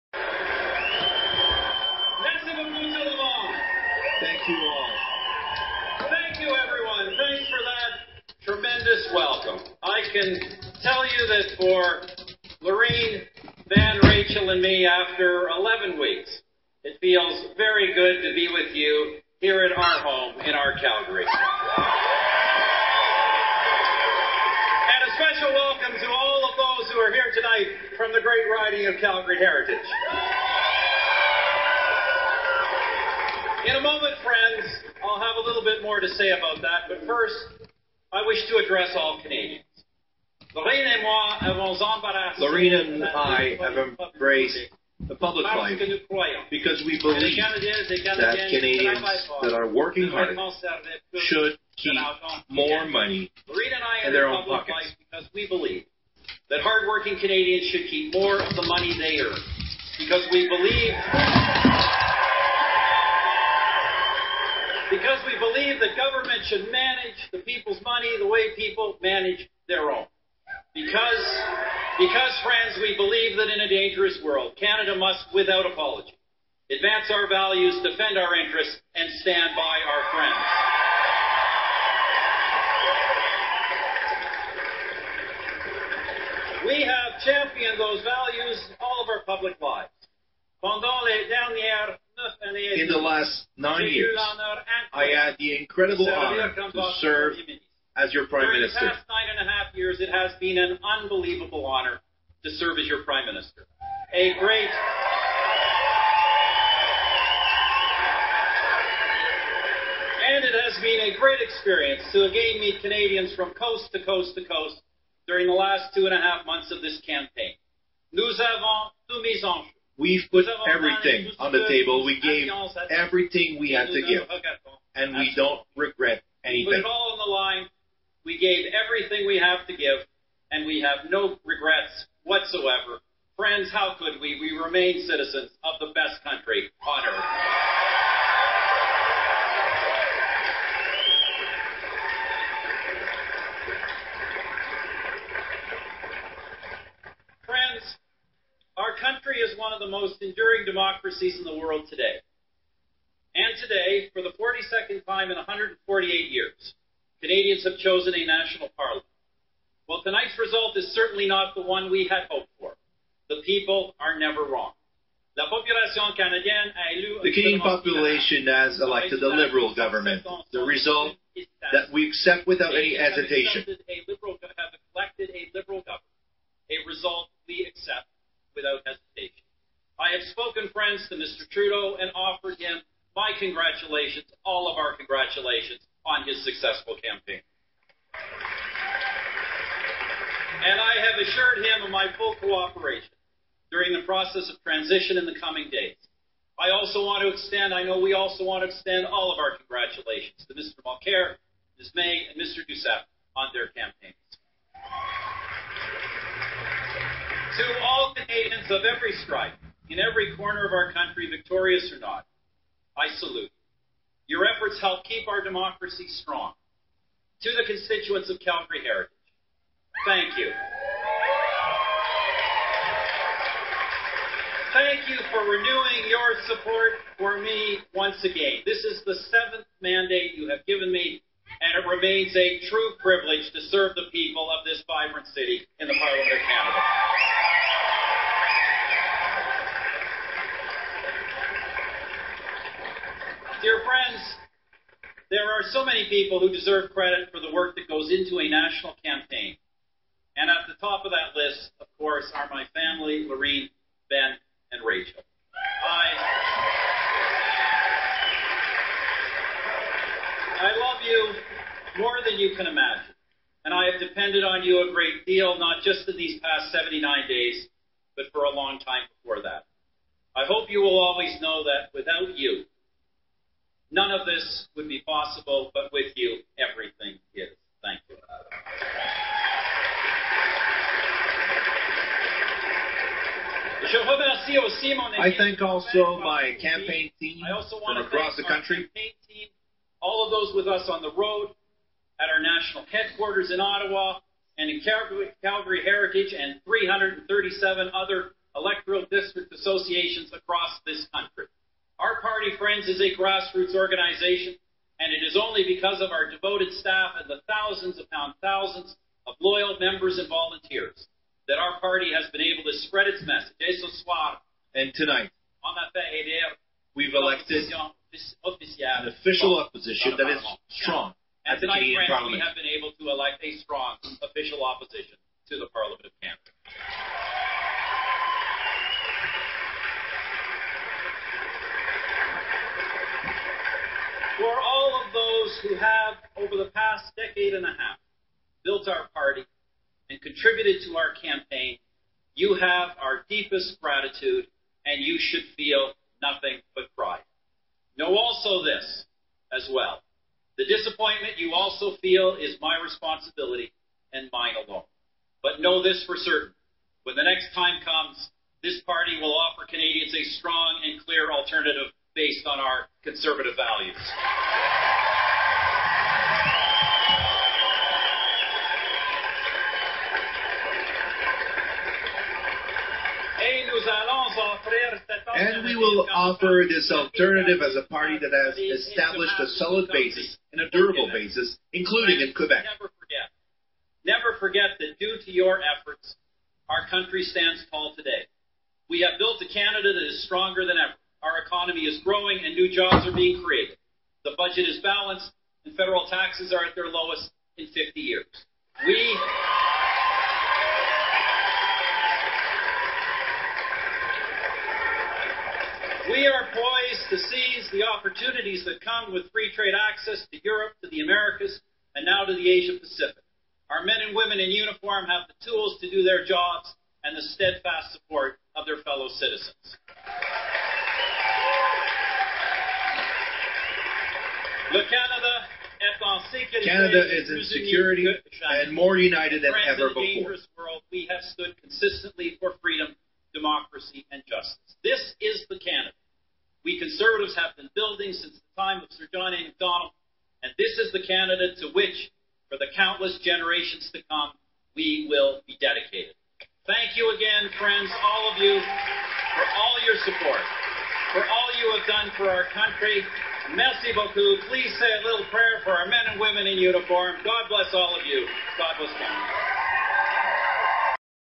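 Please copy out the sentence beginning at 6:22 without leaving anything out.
Never forget, never forget that due to your efforts, our country stands tall today.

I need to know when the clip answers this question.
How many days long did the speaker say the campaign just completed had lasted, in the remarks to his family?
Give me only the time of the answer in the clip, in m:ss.
4:26.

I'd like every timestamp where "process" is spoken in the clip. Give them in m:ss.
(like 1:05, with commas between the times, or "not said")
3:14.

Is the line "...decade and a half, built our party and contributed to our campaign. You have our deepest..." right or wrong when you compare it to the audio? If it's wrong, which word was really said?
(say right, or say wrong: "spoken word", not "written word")
right.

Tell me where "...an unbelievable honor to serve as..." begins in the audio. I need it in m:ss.
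1:40.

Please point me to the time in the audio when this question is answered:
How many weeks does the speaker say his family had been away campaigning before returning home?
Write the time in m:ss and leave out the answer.
0:15.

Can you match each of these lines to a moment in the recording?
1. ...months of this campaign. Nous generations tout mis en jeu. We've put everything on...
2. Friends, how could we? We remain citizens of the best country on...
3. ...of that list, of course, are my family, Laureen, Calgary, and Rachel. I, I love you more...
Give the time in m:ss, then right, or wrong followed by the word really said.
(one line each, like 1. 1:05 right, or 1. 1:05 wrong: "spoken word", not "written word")
1. 1:56 wrong: "avons", not "generations"
2. 2:13 right
3. 4:11 wrong: "Ben", not "Calgary".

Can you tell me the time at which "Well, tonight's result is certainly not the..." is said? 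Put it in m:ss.
2:39.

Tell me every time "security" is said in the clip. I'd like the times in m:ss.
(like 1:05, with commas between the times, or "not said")
7:07.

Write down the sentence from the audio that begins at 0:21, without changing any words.
And a special welcome to all of those who are here tonight from the great riding of Calgary Heritage.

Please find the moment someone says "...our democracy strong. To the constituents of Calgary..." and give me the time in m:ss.
3:35.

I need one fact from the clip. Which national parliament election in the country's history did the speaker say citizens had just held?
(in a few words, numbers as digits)
42nd.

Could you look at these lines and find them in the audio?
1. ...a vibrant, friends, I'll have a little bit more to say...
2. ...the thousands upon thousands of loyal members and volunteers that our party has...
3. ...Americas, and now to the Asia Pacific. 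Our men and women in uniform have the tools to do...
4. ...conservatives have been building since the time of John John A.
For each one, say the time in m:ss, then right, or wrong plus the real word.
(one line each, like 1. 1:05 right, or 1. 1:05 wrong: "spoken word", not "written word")
1. 0:33 wrong: "moment", not "vibrant"
2. 5:07 right
3. 6:51 right
4. 7:16 wrong: "Sir", not "John".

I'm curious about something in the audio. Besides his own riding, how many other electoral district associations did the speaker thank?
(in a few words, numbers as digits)
337.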